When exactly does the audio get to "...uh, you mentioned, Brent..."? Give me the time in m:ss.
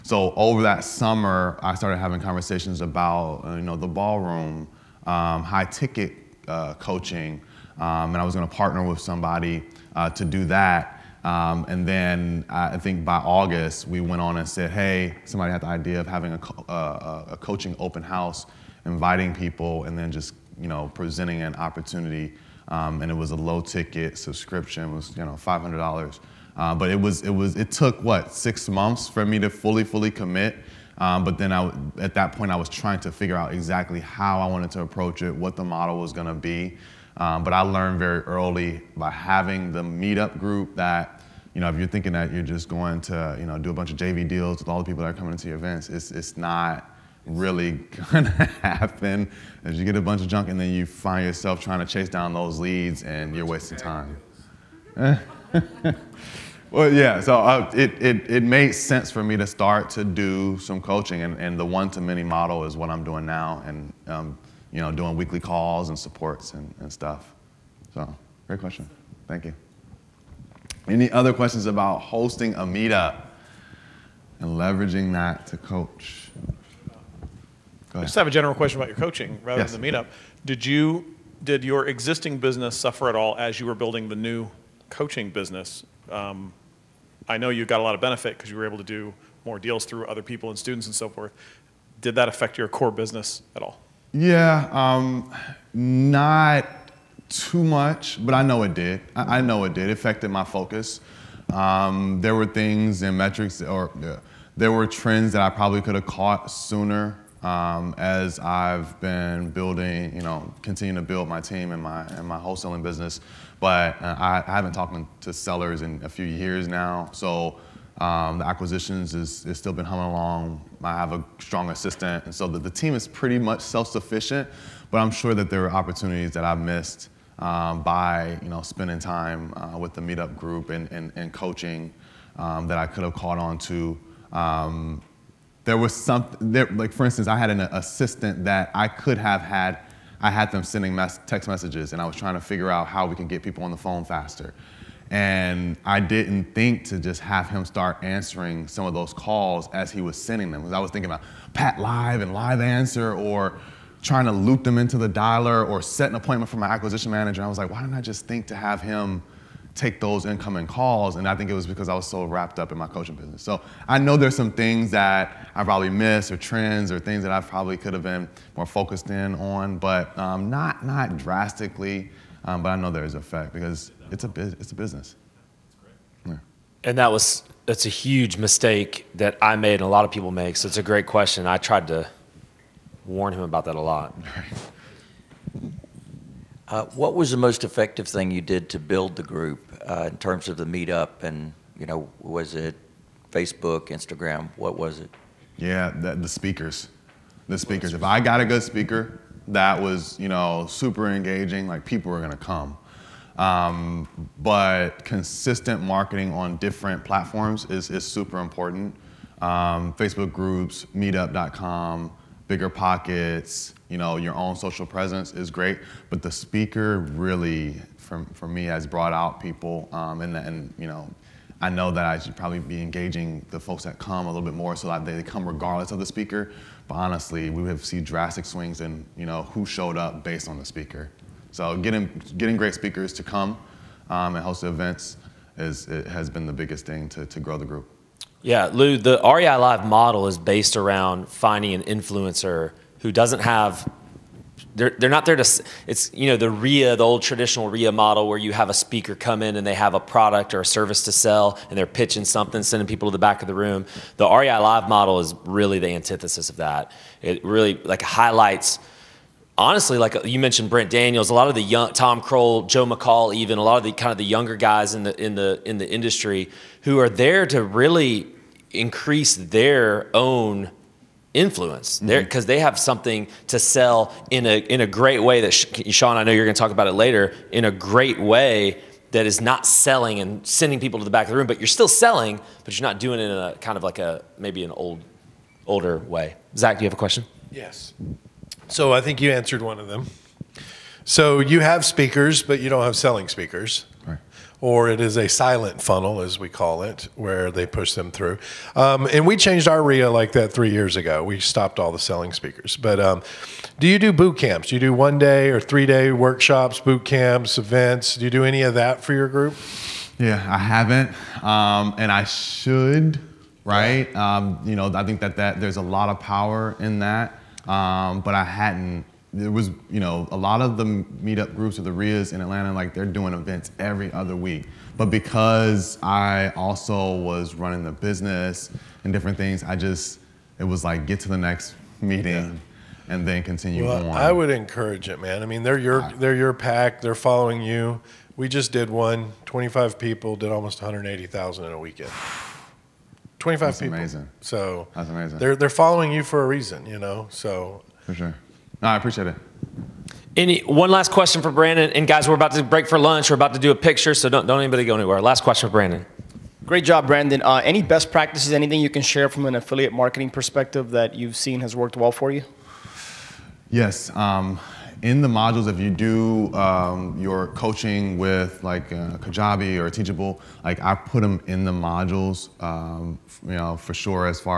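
4:20.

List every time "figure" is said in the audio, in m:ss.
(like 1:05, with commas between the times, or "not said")
0:33, 2:22.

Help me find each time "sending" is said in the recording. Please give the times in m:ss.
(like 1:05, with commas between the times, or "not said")
2:20, 2:30, 4:12, 4:40.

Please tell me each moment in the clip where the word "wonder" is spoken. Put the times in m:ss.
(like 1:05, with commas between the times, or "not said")
not said.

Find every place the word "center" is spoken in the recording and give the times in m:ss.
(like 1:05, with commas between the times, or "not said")
not said.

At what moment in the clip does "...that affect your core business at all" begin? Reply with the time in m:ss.
1:32.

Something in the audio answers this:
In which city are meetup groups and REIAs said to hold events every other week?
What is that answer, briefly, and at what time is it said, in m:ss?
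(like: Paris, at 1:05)
Atlanta, at 5:22.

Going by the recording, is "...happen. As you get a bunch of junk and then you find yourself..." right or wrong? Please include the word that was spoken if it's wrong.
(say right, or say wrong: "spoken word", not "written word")
right.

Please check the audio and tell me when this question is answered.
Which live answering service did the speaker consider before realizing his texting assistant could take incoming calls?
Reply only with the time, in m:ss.
2:31.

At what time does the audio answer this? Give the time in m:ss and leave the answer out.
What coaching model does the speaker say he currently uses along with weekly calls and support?
1:01.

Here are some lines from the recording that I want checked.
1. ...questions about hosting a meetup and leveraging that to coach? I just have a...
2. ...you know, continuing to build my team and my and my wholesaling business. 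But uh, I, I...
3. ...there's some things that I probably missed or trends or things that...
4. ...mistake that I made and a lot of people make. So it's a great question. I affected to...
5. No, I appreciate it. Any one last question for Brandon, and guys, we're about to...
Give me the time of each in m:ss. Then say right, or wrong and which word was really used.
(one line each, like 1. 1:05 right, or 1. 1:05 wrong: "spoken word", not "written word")
1. 1:11 right
2. 1:50 right
3. 2:44 right
4. 2:58 wrong: "tried", not "affected"
5. 5:48 right.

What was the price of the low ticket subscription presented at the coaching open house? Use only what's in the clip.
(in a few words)
$500.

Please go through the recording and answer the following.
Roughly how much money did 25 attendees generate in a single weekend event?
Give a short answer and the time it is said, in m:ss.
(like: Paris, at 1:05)
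180,000, at 5:40.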